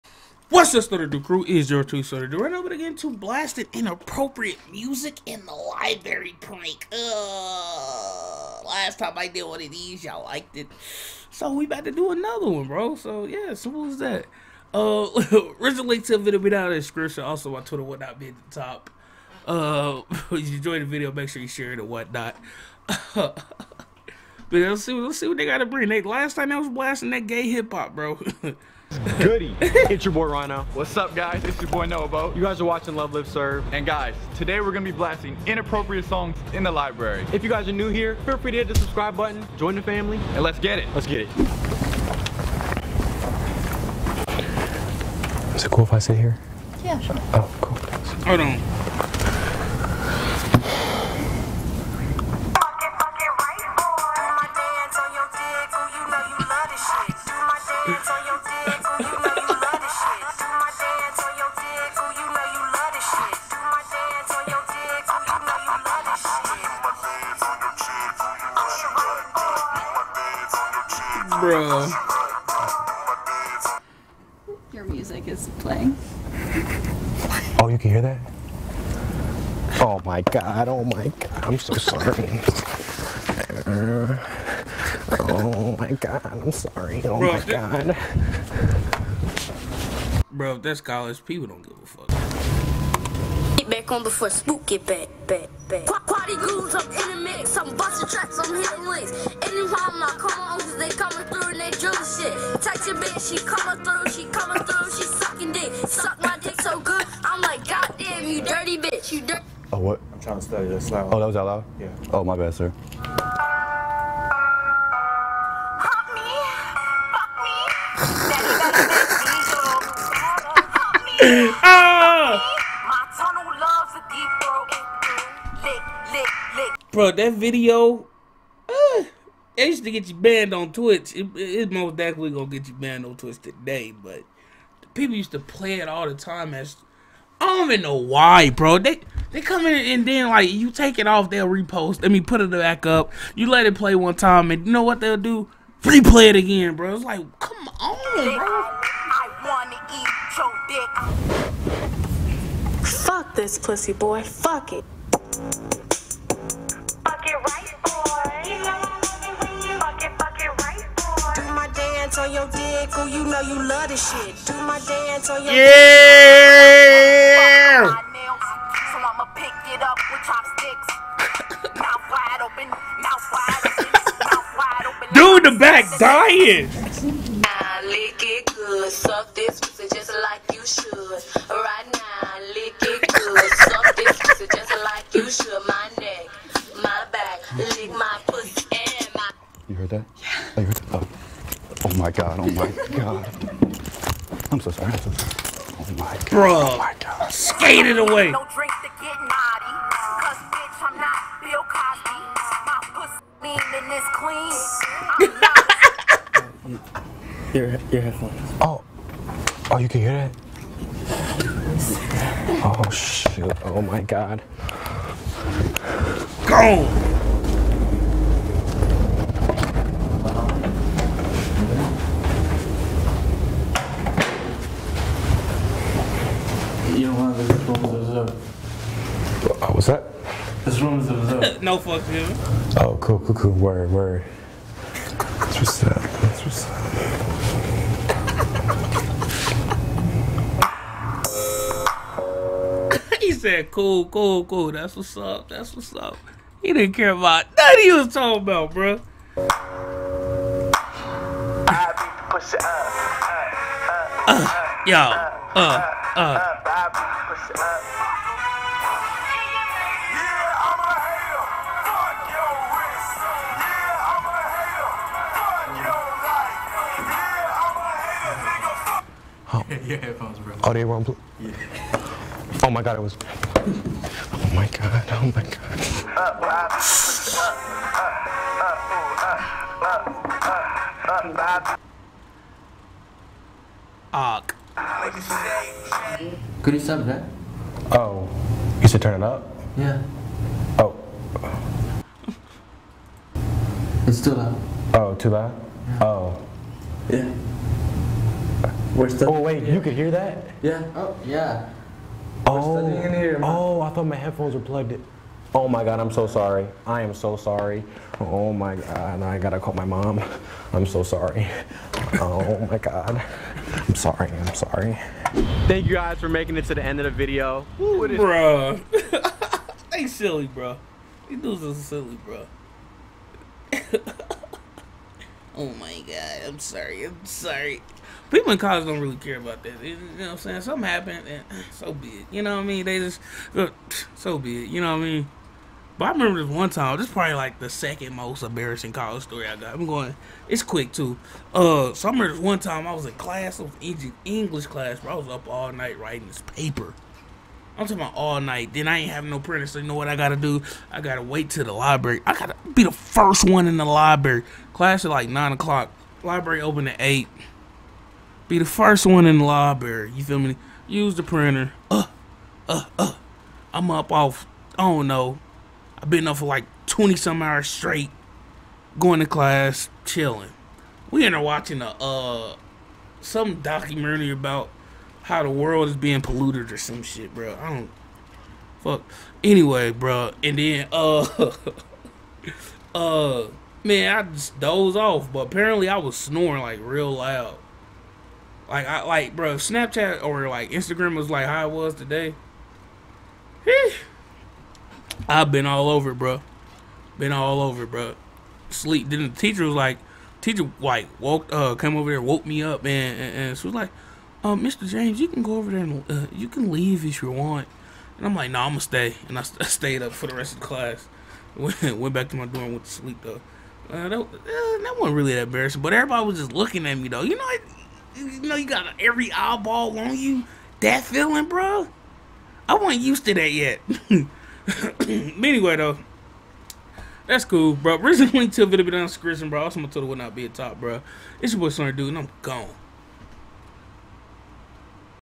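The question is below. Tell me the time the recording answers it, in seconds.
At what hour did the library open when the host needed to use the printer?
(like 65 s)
356 s.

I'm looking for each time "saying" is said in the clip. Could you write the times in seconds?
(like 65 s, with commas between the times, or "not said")
330 s.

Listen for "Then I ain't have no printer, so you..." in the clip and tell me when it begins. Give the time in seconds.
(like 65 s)
348 s.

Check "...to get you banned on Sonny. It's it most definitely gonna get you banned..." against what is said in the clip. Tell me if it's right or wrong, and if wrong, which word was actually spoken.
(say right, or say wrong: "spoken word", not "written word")
wrong: "Twitch", not "Sonny".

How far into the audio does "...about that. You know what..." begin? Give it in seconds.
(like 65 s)
329 s.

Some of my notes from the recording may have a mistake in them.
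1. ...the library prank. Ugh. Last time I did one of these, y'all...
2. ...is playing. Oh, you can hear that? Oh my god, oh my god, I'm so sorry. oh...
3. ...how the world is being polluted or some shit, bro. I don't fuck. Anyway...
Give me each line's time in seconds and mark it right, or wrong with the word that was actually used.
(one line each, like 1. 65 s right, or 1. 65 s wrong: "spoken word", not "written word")
1. 5 s right
2. 75 s right
3. 375 s right.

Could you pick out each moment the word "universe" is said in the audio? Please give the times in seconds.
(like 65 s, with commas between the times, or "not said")
not said.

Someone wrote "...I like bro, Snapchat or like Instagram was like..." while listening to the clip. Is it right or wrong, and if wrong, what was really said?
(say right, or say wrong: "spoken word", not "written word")
right.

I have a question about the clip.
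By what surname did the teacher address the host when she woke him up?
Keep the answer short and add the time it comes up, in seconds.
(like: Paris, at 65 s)
Mr. James, at 404 s.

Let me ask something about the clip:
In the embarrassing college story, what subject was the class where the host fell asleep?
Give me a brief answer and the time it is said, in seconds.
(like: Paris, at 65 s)
English, at 344 s.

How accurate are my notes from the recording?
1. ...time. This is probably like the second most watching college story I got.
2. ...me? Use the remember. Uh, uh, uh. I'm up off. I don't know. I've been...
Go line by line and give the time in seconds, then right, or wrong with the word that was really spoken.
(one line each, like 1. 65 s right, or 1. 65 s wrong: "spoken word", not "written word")
1. 336 s wrong: "embarrassing", not "watching"
2. 360 s wrong: "printer", not "remember".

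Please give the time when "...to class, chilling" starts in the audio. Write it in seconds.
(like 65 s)
369 s.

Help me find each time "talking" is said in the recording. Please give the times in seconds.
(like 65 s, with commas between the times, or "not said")
248 s, 347 s.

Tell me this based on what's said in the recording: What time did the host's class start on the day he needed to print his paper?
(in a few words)
9 o'clock.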